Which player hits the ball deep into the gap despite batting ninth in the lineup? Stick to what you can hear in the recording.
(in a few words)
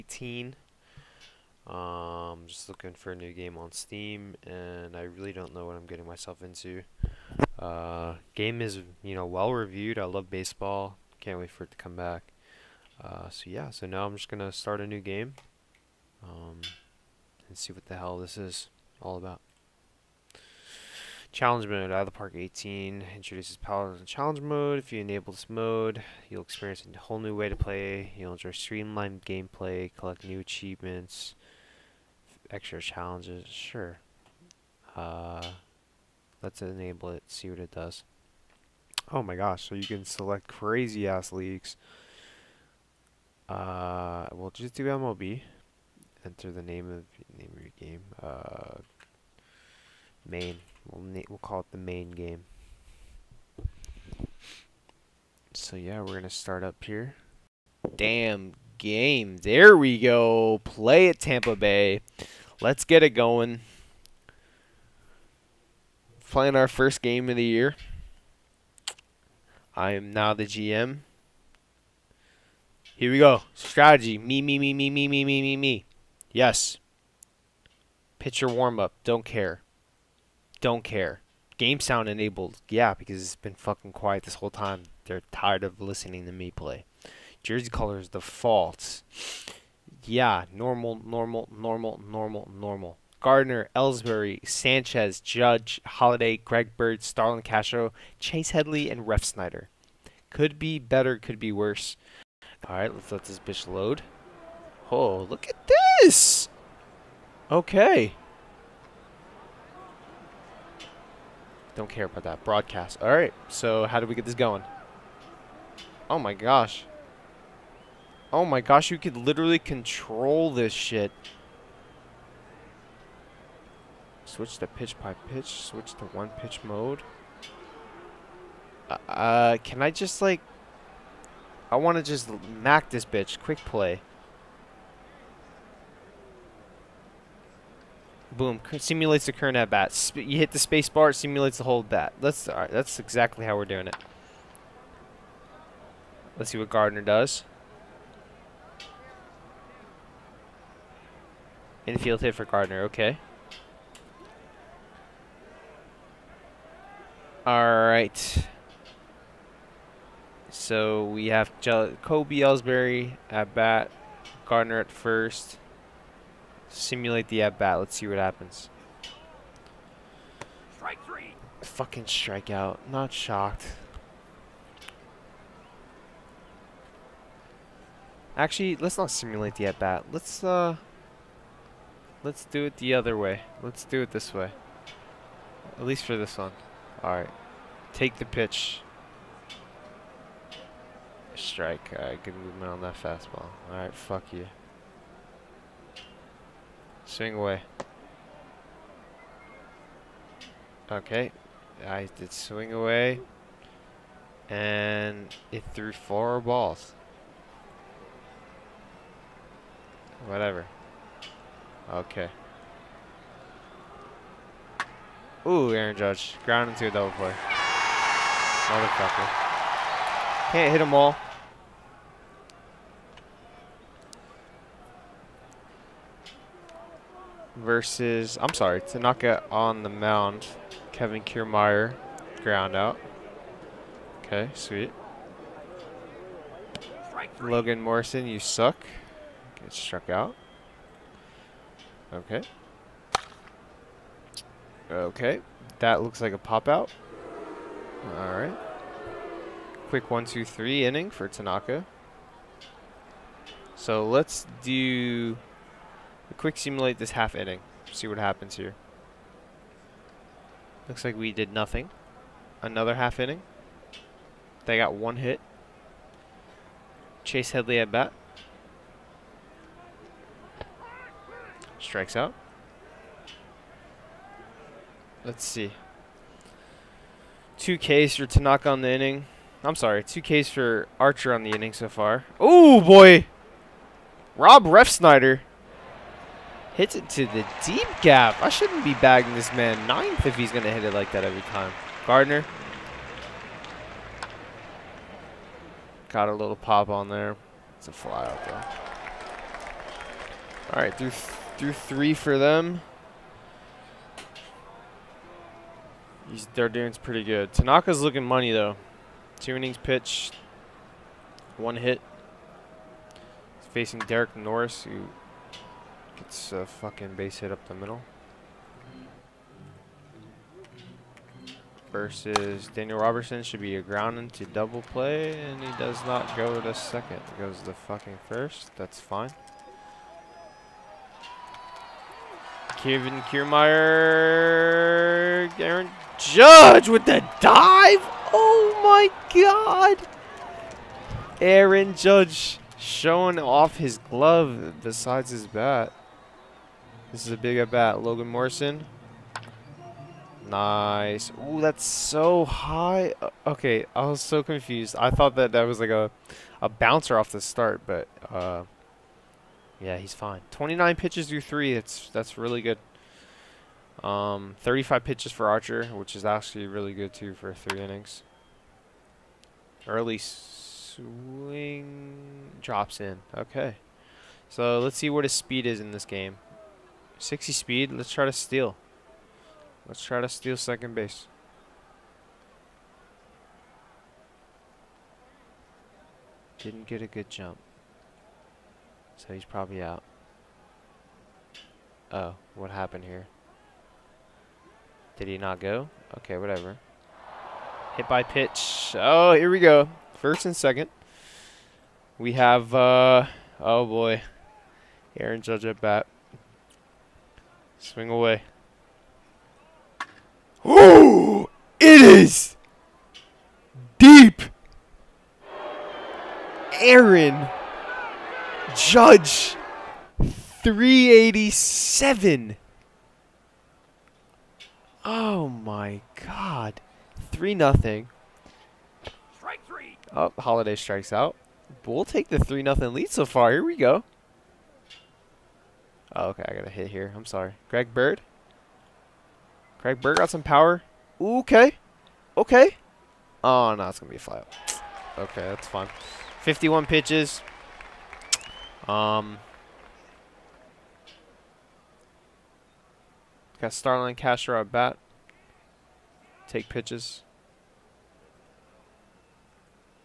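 Rob Refsnyder.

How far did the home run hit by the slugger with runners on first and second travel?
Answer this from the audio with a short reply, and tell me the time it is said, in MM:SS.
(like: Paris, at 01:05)
387, at 07:00.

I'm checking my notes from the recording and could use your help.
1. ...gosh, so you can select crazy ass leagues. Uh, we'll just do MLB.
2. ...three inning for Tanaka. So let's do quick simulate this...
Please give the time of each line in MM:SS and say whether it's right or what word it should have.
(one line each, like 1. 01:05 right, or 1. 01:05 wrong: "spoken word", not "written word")
1. 00:39 right
2. 04:10 right.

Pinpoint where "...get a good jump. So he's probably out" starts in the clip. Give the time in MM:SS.
06:26.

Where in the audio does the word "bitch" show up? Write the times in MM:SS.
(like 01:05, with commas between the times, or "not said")
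01:43, 02:13.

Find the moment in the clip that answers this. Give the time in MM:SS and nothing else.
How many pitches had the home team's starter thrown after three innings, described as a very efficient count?
06:00.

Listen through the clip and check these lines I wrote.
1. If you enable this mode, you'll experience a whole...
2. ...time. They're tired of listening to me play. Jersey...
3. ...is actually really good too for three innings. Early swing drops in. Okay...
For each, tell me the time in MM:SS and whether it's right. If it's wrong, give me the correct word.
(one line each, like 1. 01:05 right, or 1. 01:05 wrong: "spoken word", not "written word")
1. 00:24 right
2. 01:24 right
3. 06:06 right.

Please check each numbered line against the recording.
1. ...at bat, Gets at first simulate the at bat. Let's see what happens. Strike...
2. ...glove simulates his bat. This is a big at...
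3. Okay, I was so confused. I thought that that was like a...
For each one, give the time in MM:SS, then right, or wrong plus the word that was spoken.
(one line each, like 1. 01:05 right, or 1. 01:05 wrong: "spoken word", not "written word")
1. 02:43 wrong: "Gardner", not "Gets"
2. 05:44 wrong: "besides", not "simulates"
3. 05:53 right.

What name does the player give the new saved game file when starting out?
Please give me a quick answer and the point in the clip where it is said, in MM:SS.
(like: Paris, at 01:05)
The main game, at 00:51.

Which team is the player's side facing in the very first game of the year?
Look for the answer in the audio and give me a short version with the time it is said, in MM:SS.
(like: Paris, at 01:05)
Tampa Bay, at 01:01.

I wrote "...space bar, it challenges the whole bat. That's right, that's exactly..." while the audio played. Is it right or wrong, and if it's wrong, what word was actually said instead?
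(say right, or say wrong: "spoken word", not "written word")
wrong: "simulates", not "challenges".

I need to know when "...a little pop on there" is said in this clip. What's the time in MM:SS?
04:56.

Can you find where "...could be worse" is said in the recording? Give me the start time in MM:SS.
01:41.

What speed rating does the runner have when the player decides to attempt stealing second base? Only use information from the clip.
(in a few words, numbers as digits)
60.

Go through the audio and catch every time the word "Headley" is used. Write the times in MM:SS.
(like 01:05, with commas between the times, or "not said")
01:38, 04:27.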